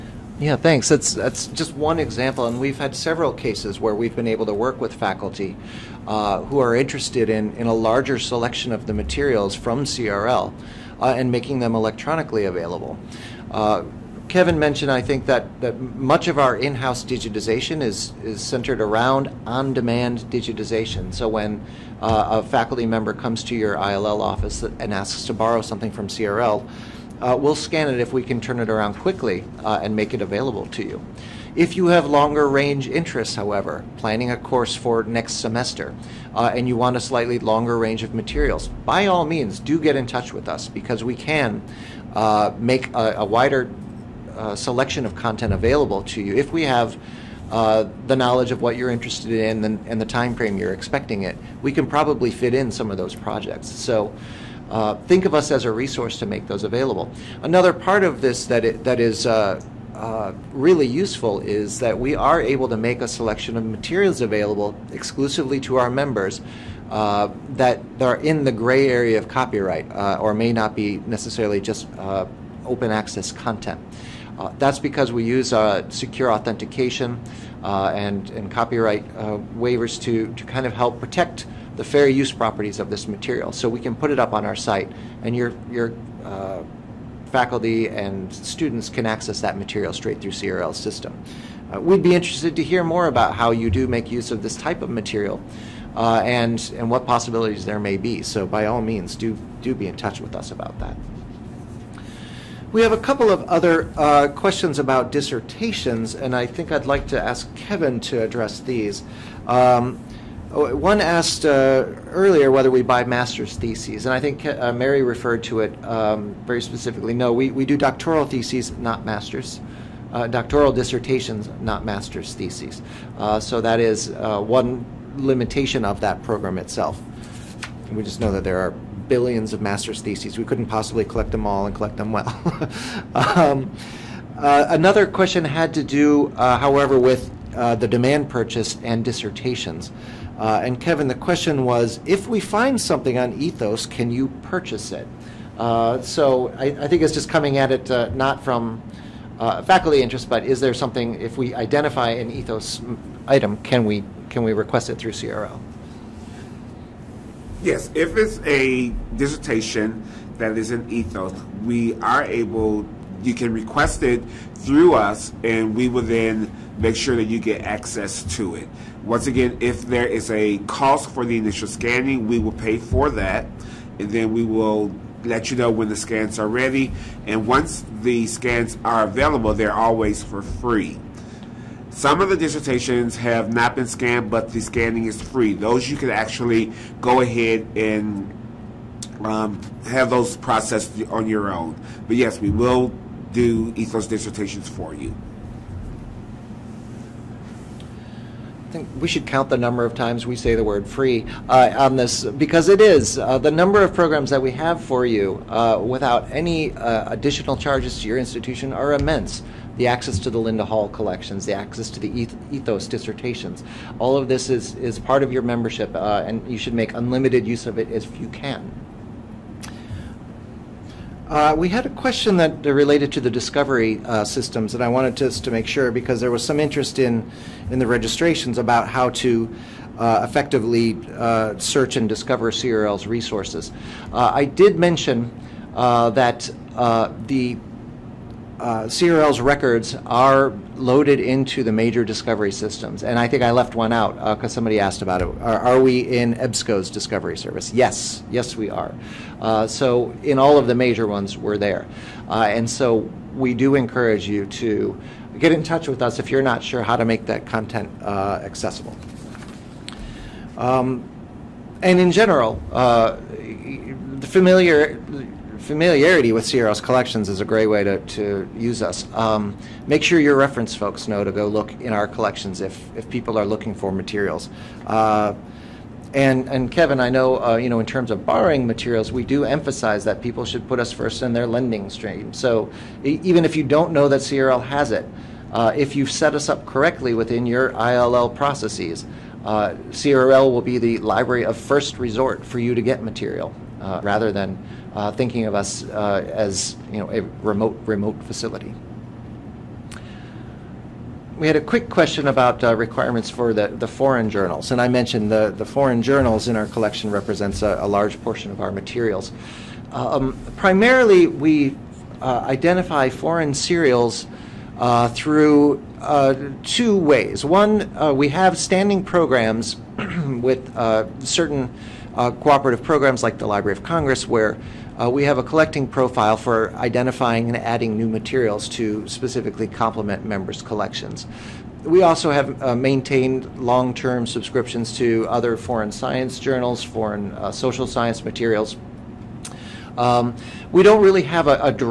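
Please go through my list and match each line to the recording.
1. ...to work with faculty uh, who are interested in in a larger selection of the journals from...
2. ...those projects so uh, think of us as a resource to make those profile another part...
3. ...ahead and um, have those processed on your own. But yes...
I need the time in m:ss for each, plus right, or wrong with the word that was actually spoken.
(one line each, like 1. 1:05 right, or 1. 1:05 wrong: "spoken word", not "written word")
1. 0:04 wrong: "materials", not "journals"
2. 0:52 wrong: "available", not "profile"
3. 3:07 right.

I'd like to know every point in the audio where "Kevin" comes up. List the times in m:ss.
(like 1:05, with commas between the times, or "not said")
0:14, 1:47, 2:20, 4:36.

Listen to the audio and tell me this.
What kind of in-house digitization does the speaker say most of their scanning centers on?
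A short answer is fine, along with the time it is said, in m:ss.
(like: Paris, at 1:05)
On-demand digitization, at 0:19.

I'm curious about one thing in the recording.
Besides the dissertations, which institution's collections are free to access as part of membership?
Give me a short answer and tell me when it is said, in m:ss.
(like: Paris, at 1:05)
Linda Hall, at 3:30.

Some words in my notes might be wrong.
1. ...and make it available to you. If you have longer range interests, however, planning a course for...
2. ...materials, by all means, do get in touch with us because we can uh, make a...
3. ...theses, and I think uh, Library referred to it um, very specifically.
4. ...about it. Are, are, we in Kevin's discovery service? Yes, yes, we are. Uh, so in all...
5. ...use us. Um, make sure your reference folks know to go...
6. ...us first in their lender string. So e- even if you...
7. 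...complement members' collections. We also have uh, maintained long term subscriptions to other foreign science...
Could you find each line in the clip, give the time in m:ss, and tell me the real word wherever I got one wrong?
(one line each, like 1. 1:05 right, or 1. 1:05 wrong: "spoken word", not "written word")
1. 0:29 right
2. 0:38 right
3. 1:53 wrong: "Mary", not "Library"
4. 4:05 wrong: "EBSCO", not "Kevin"
5. 4:28 right
6. 4:40 right
7. 5:29 right.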